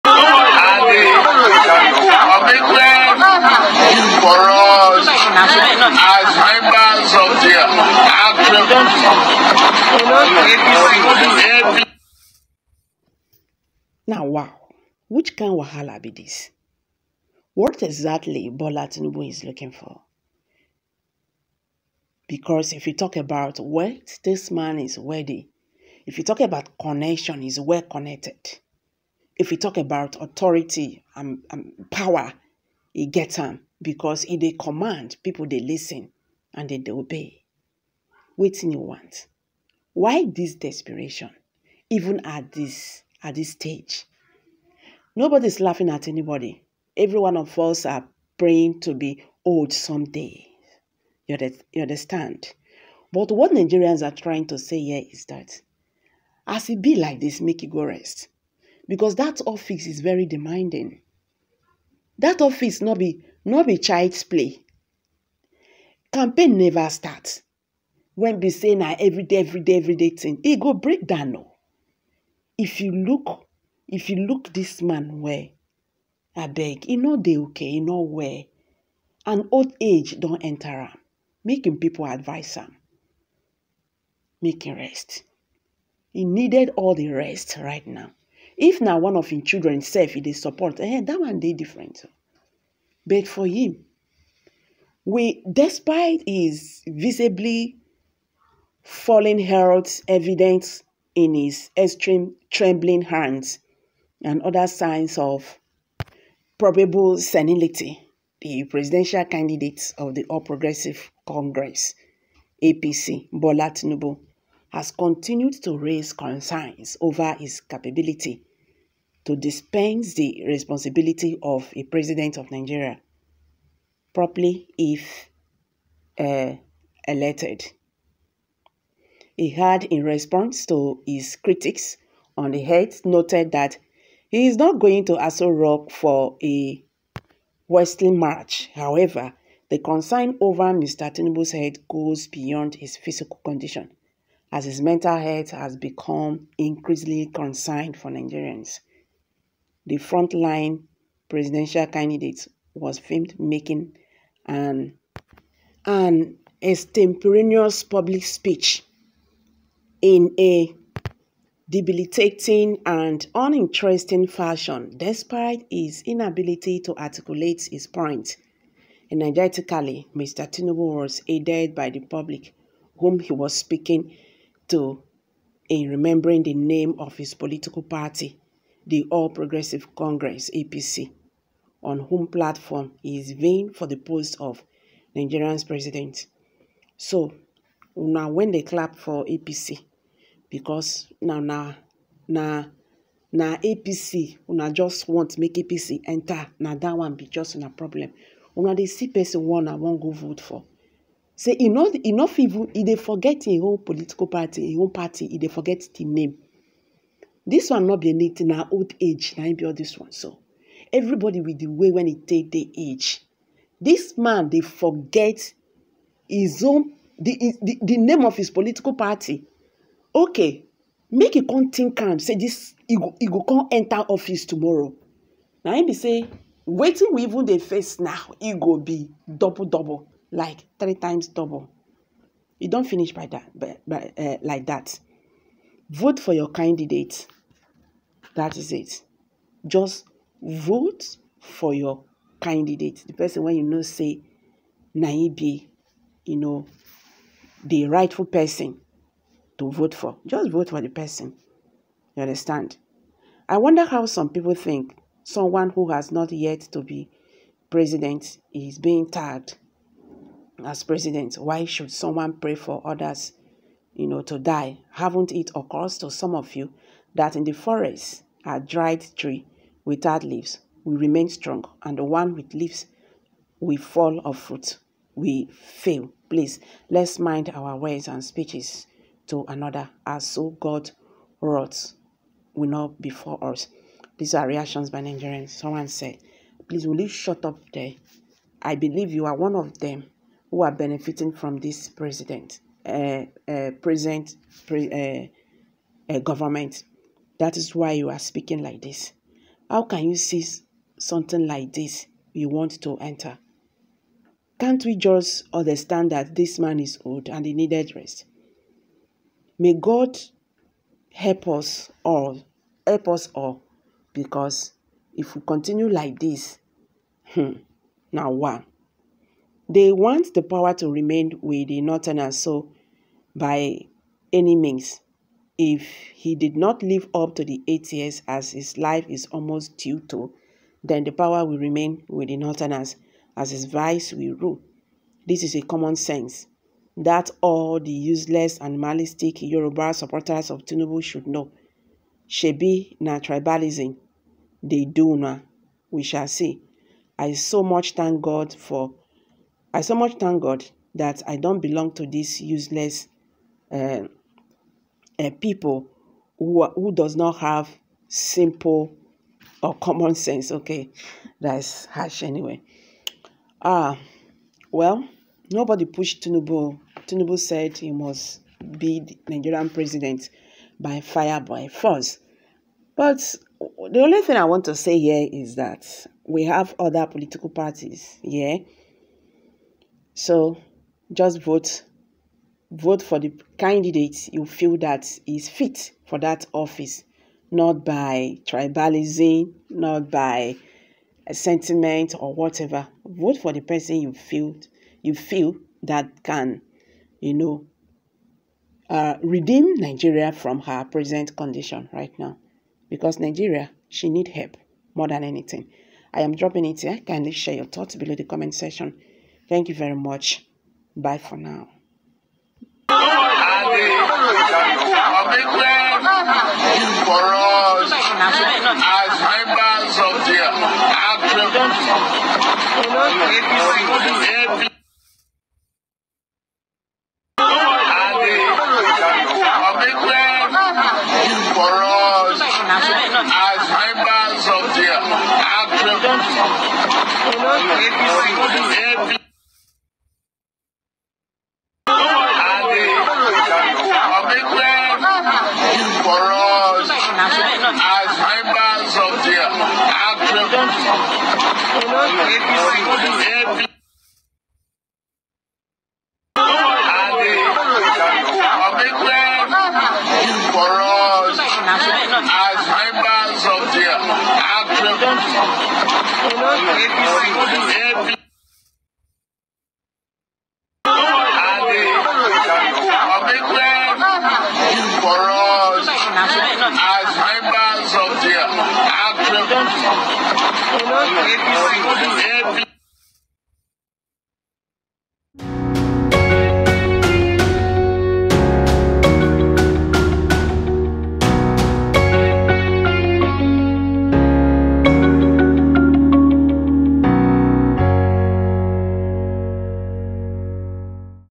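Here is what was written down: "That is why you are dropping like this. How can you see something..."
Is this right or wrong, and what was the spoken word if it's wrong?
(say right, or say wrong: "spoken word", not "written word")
wrong: "speaking", not "dropping".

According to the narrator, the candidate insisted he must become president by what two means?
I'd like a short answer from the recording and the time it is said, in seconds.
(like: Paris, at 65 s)
By fire, by force, at 370 s.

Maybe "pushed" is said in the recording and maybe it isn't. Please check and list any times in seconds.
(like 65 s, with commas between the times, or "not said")
365 s.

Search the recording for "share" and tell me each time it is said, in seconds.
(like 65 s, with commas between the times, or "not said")
407 s.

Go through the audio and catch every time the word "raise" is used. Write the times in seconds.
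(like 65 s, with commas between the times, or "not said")
115 s.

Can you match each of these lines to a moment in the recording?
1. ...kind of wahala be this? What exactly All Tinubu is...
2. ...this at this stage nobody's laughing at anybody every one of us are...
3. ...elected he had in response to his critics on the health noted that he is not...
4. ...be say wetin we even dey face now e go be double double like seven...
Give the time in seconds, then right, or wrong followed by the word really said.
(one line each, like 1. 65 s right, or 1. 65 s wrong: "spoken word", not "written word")
1. 15 s wrong: "Bola", not "All"
2. 42 s right
3. 127 s right
4. 225 s wrong: "three", not "seven".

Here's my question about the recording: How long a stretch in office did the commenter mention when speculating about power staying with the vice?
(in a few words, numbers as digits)
8 years.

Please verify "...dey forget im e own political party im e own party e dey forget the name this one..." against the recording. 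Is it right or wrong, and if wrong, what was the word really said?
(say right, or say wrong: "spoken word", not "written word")
right.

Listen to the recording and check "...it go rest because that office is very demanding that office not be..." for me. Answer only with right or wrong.
right.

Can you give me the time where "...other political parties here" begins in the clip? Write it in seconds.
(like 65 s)
376 s.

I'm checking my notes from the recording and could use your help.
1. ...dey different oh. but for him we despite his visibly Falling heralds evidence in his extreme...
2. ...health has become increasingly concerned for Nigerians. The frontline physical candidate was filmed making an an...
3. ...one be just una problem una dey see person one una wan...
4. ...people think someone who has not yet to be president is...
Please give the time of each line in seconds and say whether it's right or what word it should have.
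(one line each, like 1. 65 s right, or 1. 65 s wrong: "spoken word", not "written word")
1. 91 s right
2. 145 s wrong: "presidential", not "physical"
3. 196 s right
4. 254 s right.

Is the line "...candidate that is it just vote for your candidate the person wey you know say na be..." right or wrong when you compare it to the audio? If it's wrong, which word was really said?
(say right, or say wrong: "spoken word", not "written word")
right.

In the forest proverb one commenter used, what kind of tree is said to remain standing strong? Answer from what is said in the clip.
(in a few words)
Dried tree without leaves.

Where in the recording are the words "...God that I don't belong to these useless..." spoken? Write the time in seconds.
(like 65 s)
350 s.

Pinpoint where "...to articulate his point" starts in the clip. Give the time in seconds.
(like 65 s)
166 s.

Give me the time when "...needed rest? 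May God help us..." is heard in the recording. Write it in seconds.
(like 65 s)
307 s.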